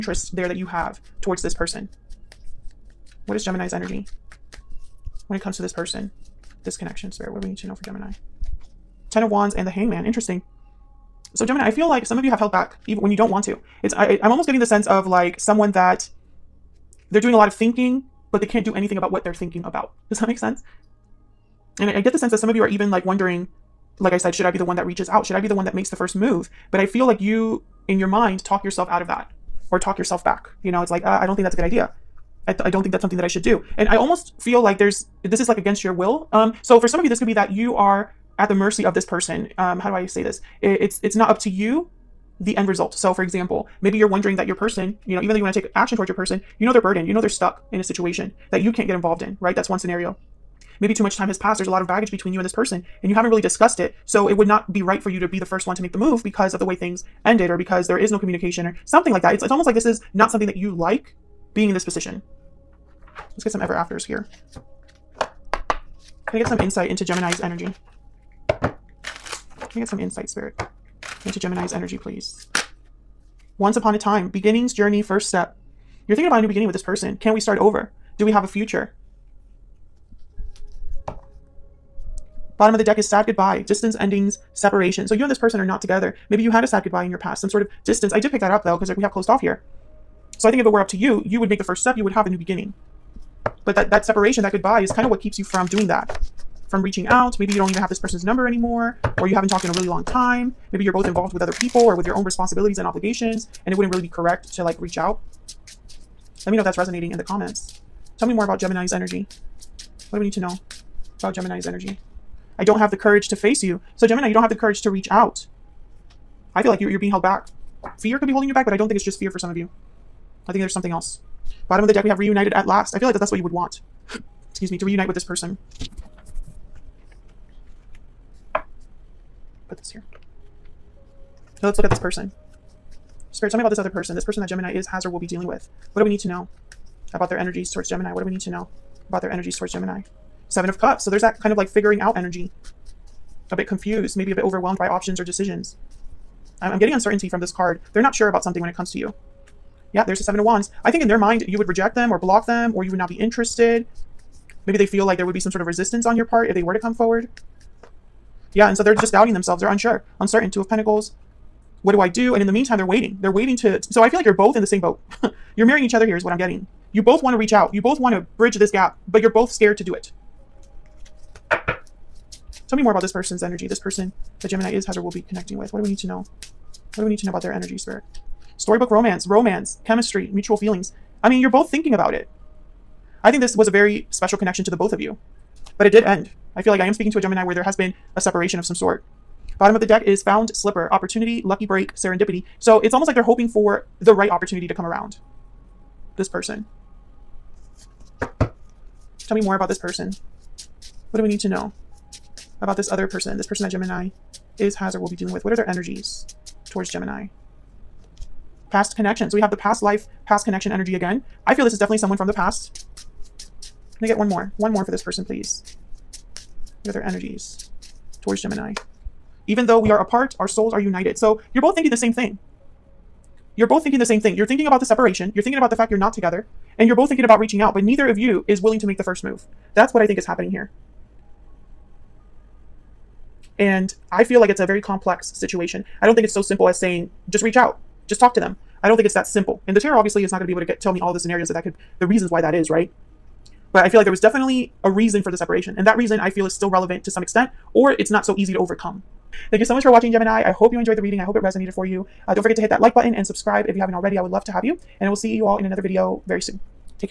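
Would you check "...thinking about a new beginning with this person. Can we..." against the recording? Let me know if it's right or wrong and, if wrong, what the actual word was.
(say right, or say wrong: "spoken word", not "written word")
right.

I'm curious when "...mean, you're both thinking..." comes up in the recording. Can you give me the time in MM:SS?
03:01.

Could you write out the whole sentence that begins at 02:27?
They're not sure about something when it comes to you.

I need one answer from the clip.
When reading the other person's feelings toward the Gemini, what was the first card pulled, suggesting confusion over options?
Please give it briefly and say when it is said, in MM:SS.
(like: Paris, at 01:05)
Seven of Cups, at 02:20.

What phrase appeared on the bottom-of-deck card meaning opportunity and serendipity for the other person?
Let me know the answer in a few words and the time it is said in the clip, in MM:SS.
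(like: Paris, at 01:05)
Found slipper, at 03:10.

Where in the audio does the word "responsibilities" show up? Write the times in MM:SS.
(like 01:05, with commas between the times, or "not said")
01:42.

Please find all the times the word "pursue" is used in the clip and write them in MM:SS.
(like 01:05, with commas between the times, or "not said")
not said.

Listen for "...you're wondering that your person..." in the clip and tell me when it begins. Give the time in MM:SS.
00:43.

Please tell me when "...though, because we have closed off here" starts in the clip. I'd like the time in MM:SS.
01:28.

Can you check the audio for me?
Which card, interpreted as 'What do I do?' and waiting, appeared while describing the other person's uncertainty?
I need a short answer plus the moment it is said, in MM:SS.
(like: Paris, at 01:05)
Two of Pentacles, at 02:40.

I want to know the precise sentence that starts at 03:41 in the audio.
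So you're both thinking the same thing.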